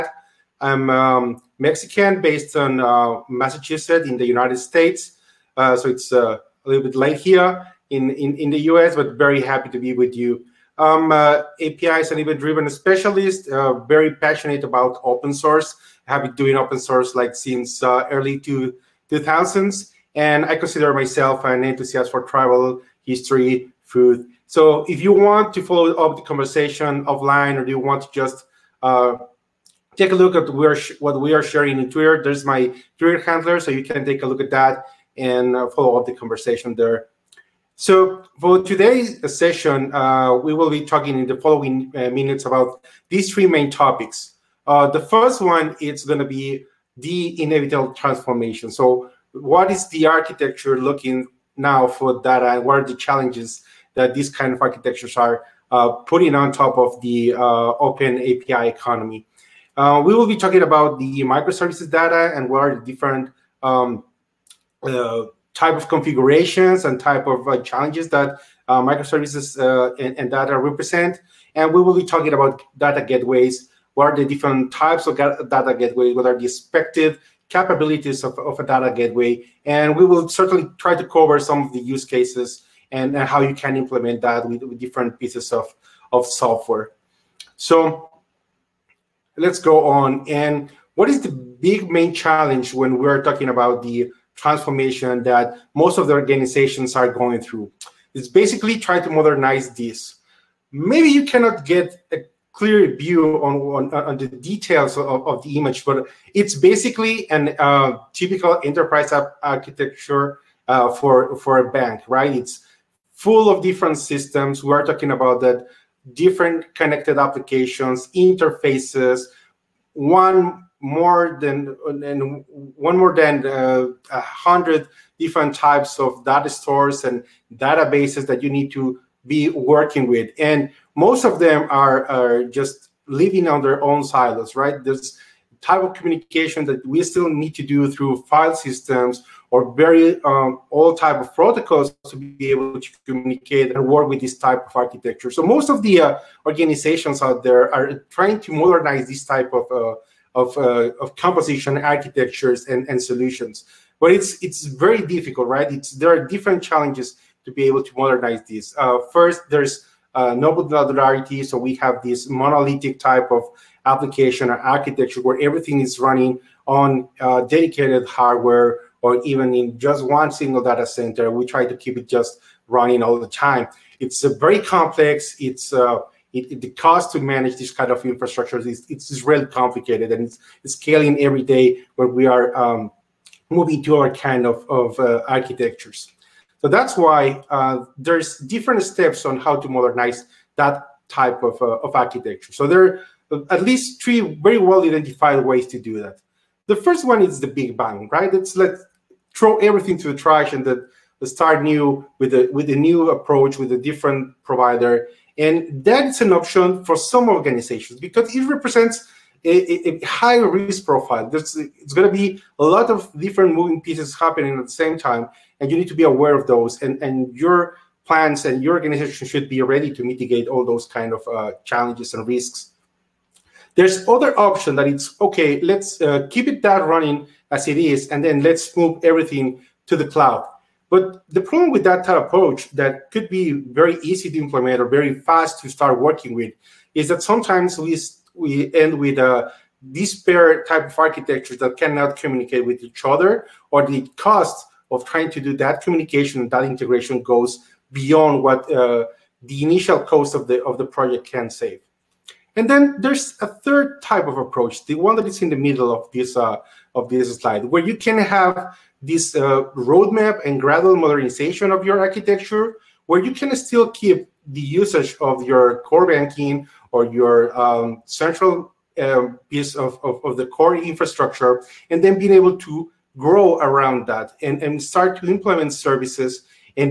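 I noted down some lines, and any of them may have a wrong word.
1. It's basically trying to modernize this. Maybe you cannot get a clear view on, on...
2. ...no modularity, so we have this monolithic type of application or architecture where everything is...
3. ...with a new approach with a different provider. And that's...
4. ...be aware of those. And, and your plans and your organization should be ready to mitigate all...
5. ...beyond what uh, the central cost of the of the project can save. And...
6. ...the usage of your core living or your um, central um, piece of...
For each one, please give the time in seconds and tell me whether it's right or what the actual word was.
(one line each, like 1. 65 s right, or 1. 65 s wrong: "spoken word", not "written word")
1. 98 s right
2. 160 s right
3. 202 s right
4. 215 s right
5. 247 s wrong: "initial", not "central"
6. 264 s wrong: "banking", not "living".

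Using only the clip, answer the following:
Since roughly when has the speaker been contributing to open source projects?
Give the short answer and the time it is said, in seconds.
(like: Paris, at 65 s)
early 2000s, at 18 s.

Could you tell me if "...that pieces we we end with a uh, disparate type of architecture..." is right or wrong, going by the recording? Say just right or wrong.
wrong.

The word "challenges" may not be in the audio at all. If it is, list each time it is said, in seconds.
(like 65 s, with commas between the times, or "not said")
52 s, 67 s, 92 s, 156 s, 221 s.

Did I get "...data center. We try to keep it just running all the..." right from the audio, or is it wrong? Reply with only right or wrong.
right.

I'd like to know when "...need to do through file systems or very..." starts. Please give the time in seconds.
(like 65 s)
137 s.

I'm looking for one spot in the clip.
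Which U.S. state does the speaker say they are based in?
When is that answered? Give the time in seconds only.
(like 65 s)
3 s.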